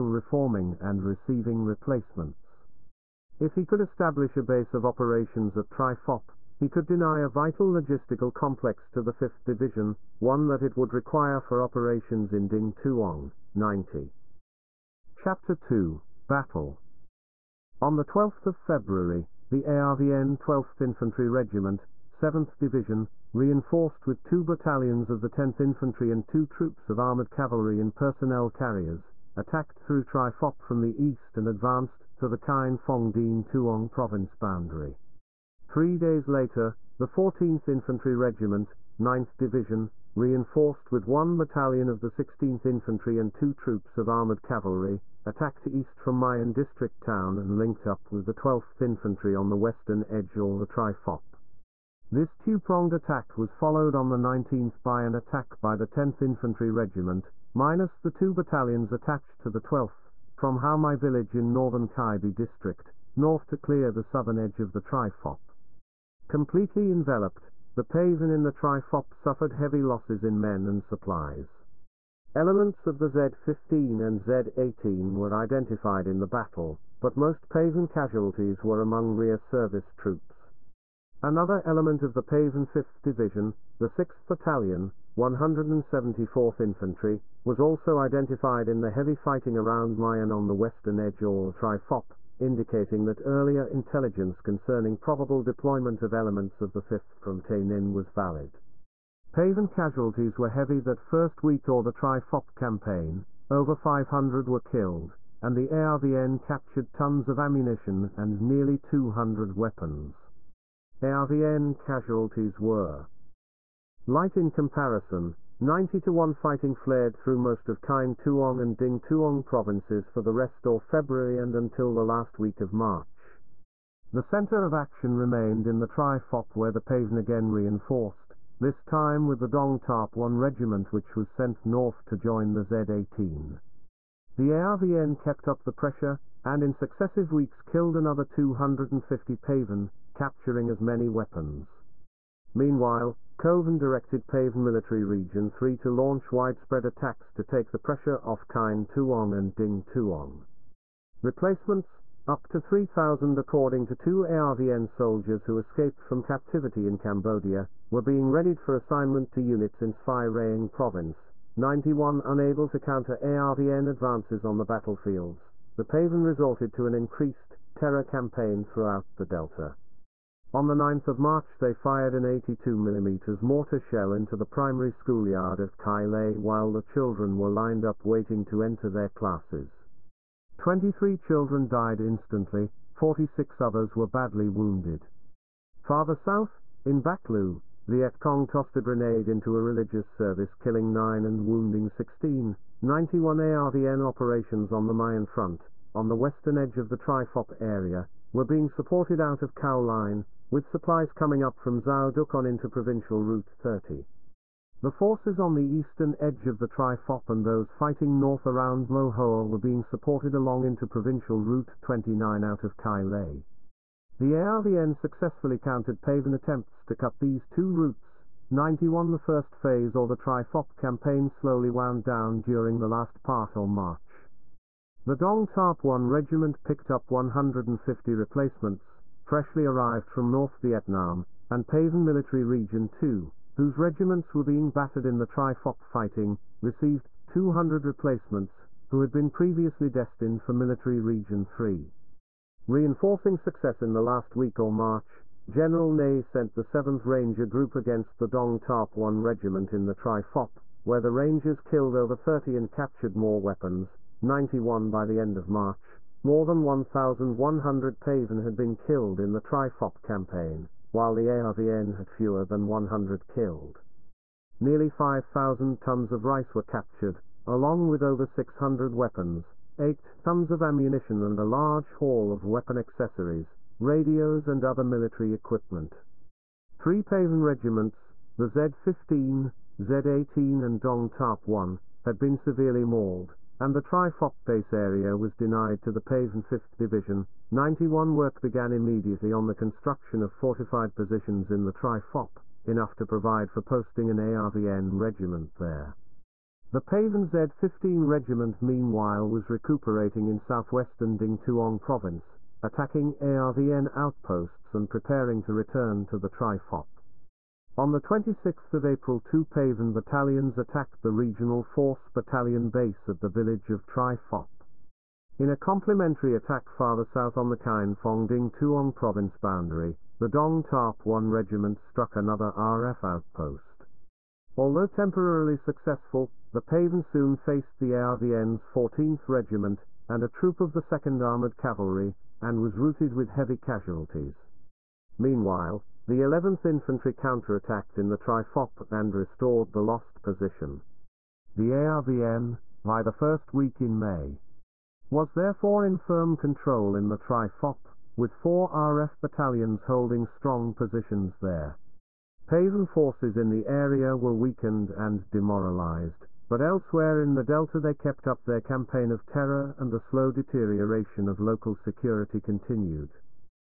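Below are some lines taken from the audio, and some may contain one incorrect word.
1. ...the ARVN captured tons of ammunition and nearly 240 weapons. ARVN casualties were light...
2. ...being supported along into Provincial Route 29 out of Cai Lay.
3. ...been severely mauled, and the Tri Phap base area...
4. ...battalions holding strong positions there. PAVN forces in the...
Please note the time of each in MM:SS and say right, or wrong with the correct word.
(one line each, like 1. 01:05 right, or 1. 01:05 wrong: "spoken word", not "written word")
1. 01:45 wrong: "200", not "240"
2. 03:29 right
3. 04:42 right
4. 05:49 right.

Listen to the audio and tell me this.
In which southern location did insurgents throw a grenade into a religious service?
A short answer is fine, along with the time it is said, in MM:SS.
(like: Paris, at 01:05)
Bac Lieu, at 03:06.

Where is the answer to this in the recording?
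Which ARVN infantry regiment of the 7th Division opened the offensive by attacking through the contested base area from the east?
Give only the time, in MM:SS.
00:20.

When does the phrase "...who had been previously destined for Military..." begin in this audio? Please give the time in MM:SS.
03:58.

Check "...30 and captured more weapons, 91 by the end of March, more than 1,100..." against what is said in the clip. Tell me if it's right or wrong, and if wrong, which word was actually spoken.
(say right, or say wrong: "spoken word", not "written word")
right.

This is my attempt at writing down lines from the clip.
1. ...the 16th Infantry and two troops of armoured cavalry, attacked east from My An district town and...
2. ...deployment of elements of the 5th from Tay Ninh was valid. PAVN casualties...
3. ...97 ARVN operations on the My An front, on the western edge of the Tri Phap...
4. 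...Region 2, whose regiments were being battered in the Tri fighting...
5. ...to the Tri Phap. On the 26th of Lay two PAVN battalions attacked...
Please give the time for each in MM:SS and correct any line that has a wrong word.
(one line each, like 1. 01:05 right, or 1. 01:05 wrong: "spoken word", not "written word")
1. 00:41 right
2. 01:35 right
3. 03:12 wrong: "91", not "97"
4. 03:52 right
5. 05:06 wrong: "April", not "Lay".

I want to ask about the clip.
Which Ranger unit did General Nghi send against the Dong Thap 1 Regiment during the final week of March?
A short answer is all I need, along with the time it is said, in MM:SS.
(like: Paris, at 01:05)
7th Ranger Group, at 04:06.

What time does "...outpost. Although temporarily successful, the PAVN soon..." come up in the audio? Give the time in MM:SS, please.
05:23.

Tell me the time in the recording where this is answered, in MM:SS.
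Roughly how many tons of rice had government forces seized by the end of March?
04:24.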